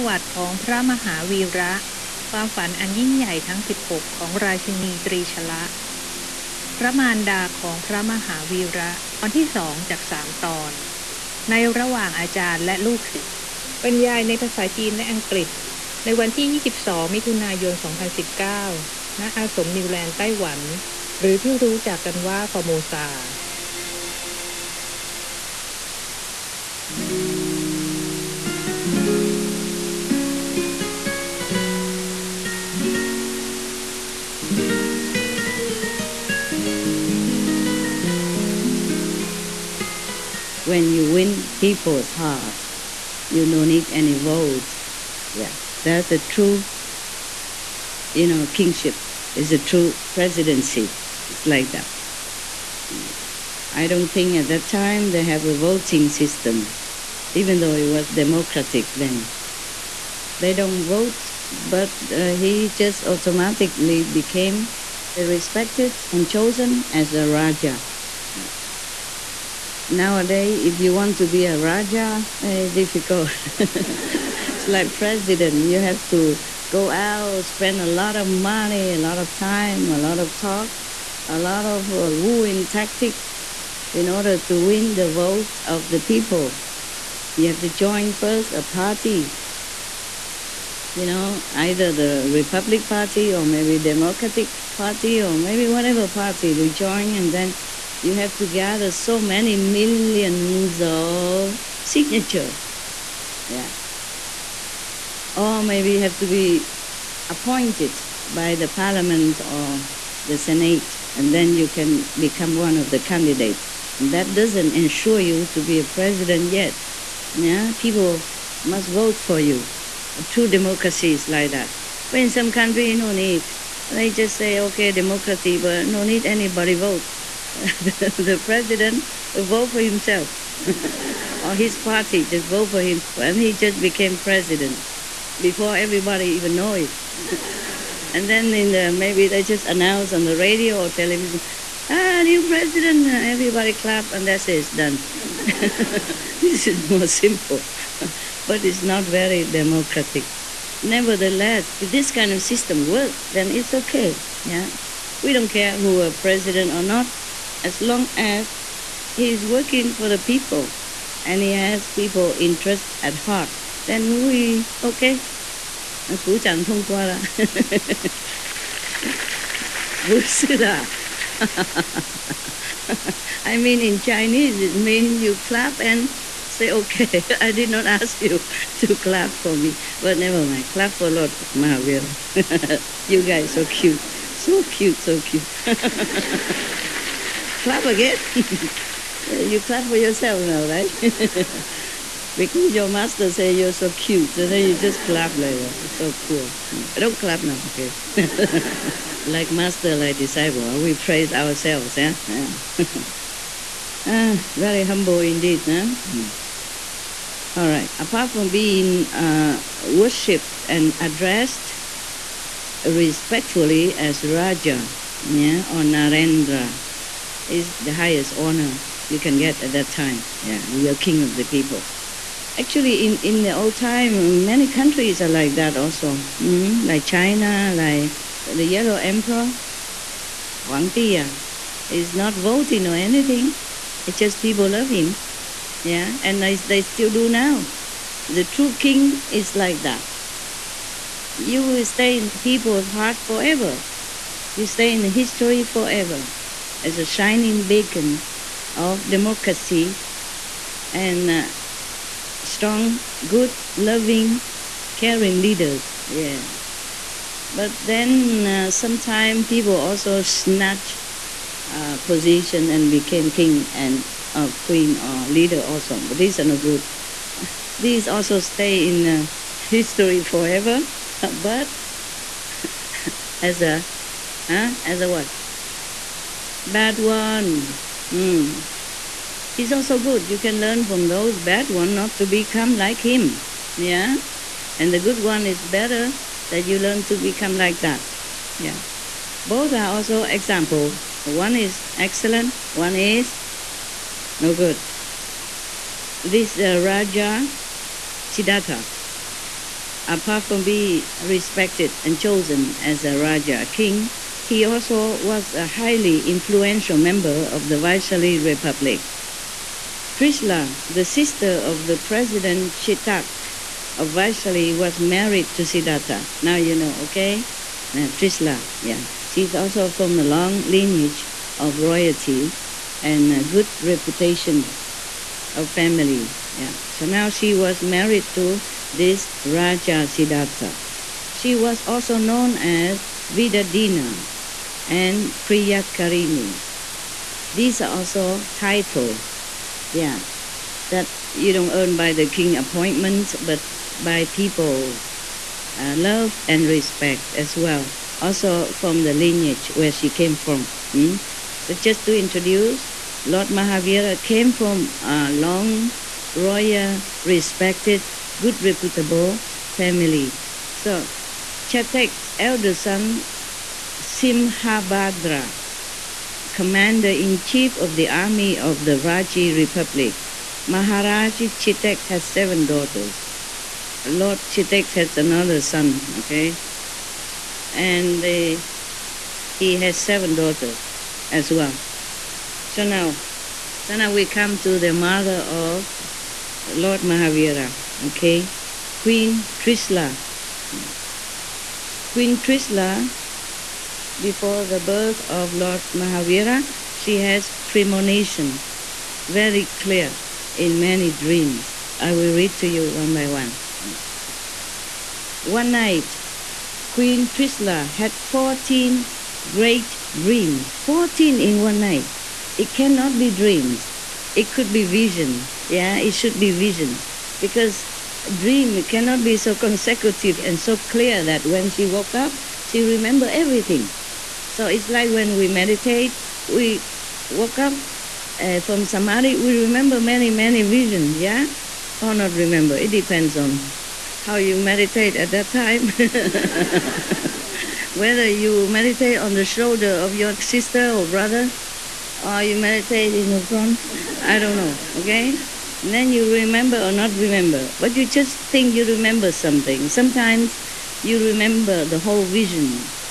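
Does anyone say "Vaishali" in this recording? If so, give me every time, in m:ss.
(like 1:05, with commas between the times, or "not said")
5:07, 5:14.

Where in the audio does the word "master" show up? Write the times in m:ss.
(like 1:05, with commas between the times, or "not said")
3:12, 3:19.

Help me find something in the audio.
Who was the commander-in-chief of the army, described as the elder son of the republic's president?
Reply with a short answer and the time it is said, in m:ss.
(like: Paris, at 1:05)
Simhabhadra, at 6:04.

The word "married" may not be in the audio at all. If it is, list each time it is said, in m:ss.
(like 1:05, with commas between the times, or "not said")
5:14, 5:27.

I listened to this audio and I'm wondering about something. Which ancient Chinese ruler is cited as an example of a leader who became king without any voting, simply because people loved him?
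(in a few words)
Yellow Emperor.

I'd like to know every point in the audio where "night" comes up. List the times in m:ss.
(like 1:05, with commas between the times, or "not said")
6:45, 6:51.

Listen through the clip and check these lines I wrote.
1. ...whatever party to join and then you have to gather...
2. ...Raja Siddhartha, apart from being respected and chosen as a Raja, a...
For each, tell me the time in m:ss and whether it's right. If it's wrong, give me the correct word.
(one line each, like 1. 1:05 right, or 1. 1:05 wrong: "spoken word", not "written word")
1. 1:35 right
2. 4:56 right.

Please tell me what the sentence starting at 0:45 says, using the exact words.
Yeah, that's a true, you know, kingship.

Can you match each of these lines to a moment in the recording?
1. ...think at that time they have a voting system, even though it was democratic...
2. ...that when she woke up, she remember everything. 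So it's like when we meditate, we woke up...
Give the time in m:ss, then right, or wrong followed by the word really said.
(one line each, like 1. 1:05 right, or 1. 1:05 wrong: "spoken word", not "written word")
1. 0:54 right
2. 7:01 right.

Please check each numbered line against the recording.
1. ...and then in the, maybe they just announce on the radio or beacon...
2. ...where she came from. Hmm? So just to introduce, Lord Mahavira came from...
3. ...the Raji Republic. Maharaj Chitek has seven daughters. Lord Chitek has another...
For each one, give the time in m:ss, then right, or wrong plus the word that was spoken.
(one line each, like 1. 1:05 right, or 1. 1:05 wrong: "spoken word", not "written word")
1. 2:18 wrong: "television", not "beacon"
2. 5:49 right
3. 6:08 right.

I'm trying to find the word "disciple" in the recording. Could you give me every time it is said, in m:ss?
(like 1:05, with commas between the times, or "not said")
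3:20.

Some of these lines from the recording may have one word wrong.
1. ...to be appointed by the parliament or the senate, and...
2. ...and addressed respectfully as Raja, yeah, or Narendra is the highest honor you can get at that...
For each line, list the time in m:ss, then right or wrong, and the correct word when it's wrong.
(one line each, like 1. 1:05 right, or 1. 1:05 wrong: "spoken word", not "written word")
1. 1:46 right
2. 3:30 right.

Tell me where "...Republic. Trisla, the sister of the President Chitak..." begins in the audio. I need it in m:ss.
5:08.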